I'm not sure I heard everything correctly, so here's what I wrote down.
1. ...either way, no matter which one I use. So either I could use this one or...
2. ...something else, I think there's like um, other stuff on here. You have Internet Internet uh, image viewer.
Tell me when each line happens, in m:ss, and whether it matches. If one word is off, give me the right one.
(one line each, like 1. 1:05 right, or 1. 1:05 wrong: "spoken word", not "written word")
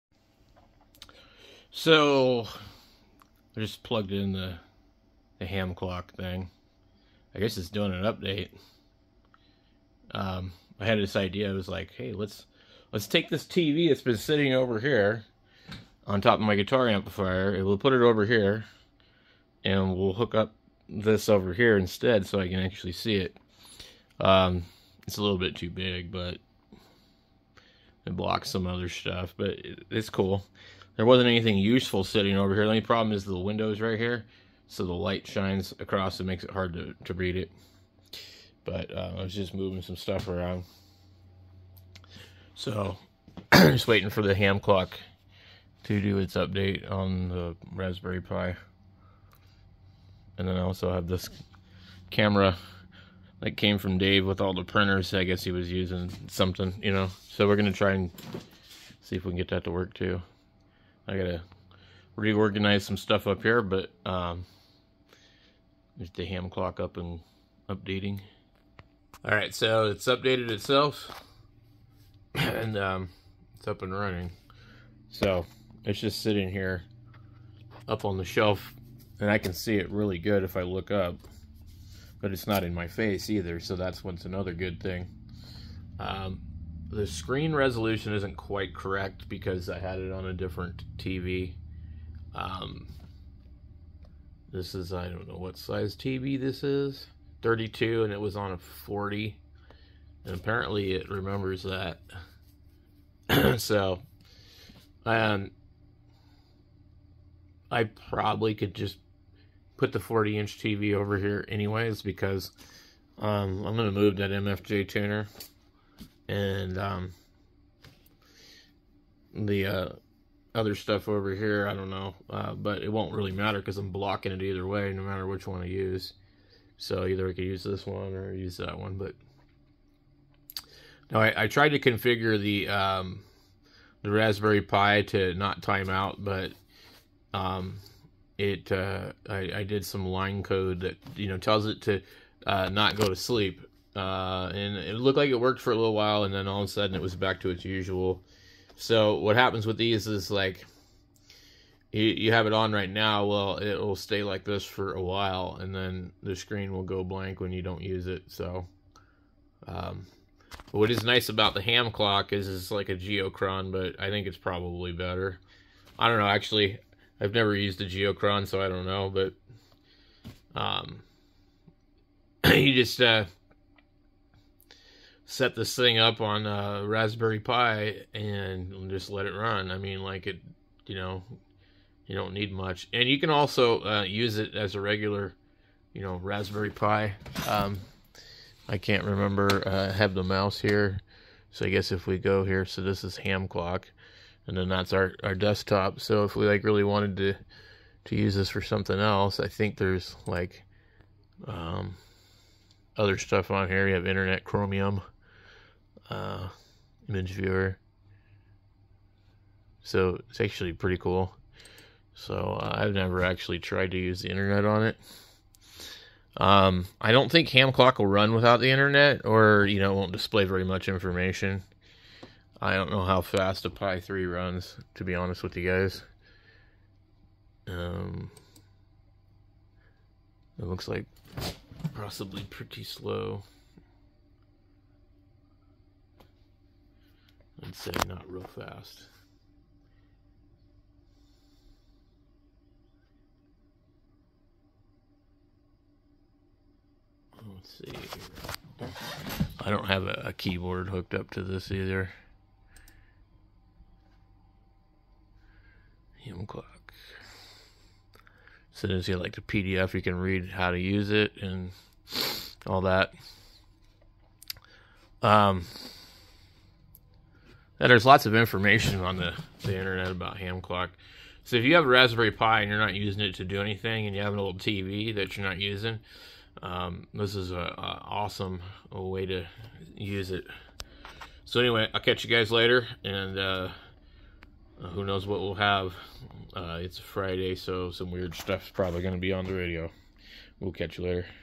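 1. 2:04 right
2. 3:18 wrong: "Chromium", not "Internet".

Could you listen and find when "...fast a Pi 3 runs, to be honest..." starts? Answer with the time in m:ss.
3:43.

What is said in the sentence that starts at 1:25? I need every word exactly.
Um, the screen resolution isn't quite correct because I had it on a different TV.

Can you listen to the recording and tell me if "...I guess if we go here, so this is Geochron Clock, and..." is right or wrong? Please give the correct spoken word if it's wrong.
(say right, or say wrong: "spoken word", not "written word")
wrong: "Ham", not "Geochron".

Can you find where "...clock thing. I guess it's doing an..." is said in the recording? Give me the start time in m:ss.
0:05.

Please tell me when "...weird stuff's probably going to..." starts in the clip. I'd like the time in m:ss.
4:48.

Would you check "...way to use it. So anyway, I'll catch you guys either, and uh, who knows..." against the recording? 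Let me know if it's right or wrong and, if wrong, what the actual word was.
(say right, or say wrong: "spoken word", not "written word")
wrong: "later", not "either".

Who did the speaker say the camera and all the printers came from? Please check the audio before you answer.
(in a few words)
Dave.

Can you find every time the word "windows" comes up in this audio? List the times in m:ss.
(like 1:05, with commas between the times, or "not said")
0:33.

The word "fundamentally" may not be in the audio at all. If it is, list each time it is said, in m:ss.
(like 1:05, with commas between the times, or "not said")
not said.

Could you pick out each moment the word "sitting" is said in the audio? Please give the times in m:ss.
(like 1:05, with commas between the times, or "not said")
0:14, 0:32, 1:16.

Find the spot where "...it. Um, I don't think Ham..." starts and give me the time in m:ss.
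3:34.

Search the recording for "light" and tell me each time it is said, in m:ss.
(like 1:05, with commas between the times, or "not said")
0:34.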